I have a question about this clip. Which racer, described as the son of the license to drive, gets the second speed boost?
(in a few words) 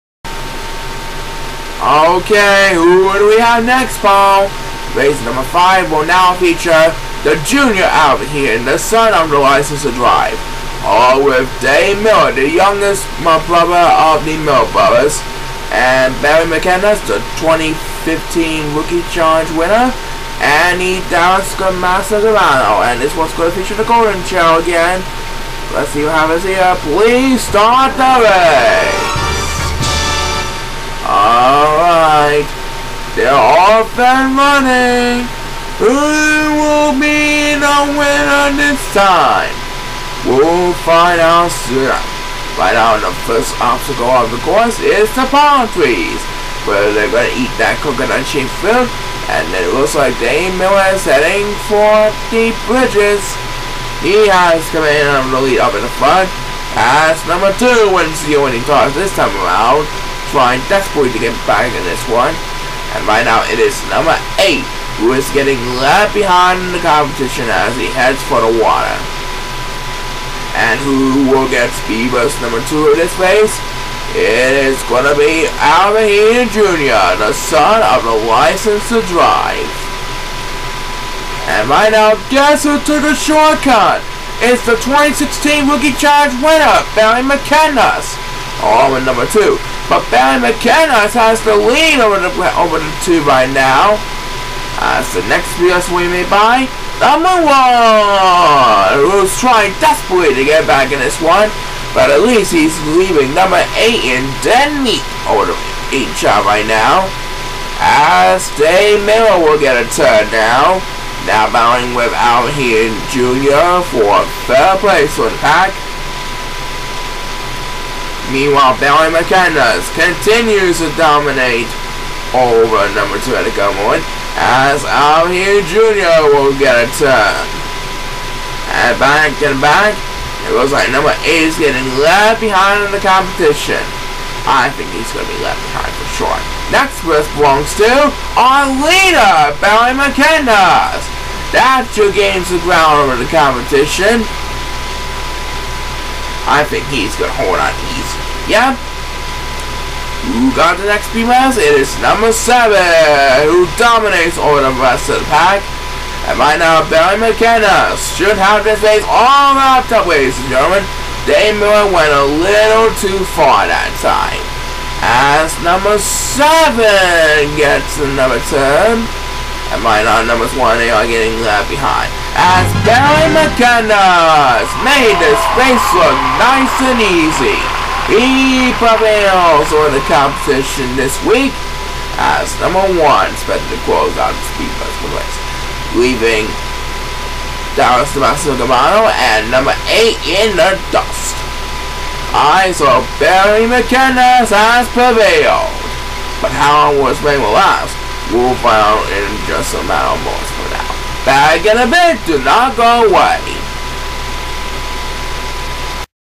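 Alvin Jr.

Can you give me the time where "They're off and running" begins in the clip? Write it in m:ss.
0:33.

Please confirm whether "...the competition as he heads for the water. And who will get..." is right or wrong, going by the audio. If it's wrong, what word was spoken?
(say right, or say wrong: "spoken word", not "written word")
right.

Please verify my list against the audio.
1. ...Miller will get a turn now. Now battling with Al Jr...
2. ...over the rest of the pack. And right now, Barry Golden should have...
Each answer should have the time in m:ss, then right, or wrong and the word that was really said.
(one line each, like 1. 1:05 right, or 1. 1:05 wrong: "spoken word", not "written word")
1. 1:49 right
2. 2:34 wrong: "Mckendas", not "Golden".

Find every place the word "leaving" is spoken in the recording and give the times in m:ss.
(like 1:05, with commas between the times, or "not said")
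1:42, 3:05.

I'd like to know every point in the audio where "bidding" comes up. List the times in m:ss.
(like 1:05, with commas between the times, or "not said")
not said.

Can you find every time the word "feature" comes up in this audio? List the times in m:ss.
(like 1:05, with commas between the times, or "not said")
0:06, 0:23.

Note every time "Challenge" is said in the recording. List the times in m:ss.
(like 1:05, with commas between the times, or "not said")
0:19, 1:25.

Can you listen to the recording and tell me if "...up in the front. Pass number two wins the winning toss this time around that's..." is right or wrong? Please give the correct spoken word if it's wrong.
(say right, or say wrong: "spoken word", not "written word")
right.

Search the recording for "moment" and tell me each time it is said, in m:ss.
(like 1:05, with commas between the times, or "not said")
2:03.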